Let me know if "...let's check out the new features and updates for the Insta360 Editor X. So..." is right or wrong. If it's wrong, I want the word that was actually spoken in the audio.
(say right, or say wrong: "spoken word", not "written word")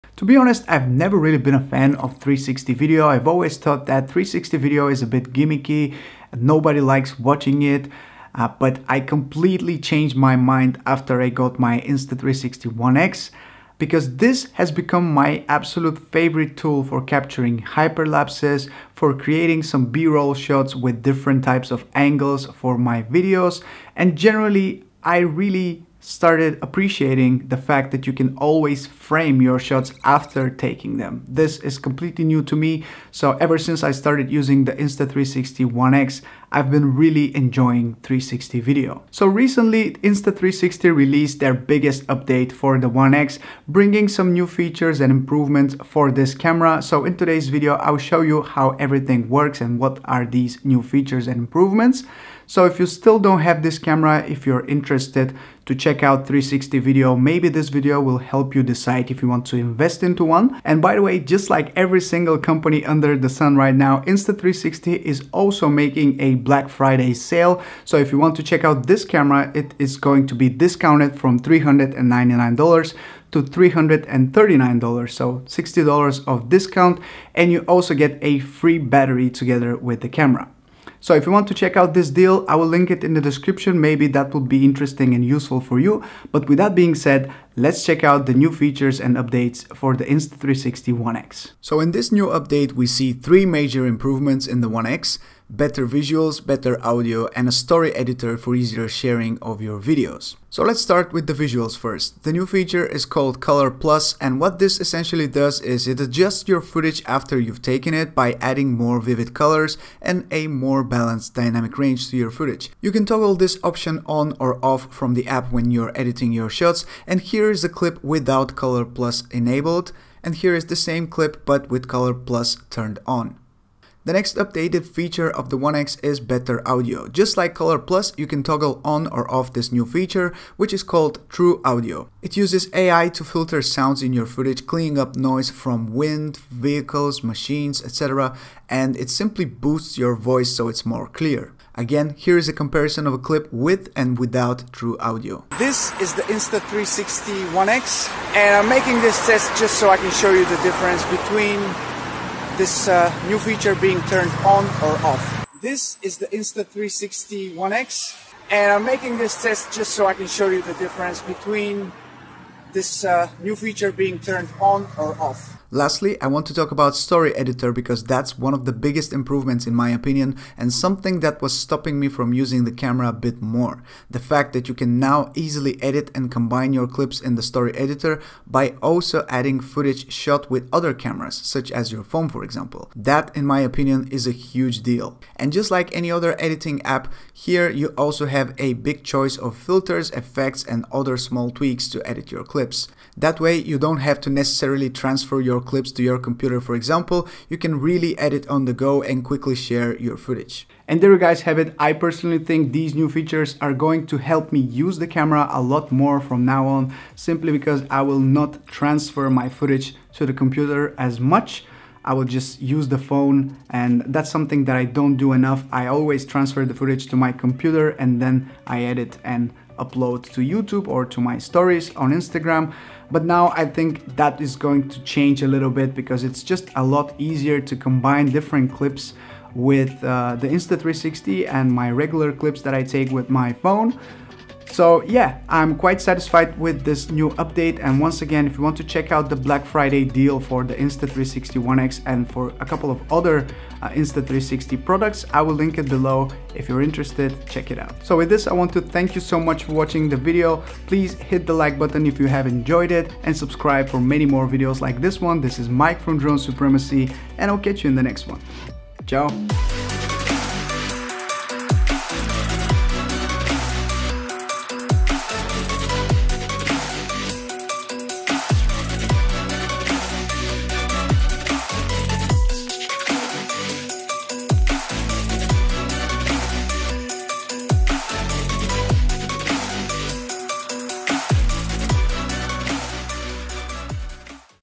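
wrong: "One", not "Editor".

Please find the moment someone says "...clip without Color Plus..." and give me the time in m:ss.
1:57.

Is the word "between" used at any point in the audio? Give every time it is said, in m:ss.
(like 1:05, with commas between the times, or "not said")
2:31, 2:41.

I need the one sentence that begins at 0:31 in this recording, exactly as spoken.
This is completely new to me, so ever since I started using the Insta360 ONE X, I've been really enjoying 360 video.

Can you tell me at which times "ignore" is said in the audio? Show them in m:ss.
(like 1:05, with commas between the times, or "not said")
not said.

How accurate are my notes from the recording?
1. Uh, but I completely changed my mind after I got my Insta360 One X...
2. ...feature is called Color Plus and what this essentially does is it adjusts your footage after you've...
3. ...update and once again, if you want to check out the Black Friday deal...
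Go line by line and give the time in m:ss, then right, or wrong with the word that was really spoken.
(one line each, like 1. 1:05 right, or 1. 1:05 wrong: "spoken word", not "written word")
1. 0:08 right
2. 1:42 right
3. 3:57 right.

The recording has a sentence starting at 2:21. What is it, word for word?
Again, here is a comparison of a clip with and without True Audio.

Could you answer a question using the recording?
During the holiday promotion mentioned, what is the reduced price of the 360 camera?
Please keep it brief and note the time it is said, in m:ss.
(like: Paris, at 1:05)
$339, at 1:13.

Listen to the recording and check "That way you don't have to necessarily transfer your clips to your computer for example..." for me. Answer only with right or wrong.
right.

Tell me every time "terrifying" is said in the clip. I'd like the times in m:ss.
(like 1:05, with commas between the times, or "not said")
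not said.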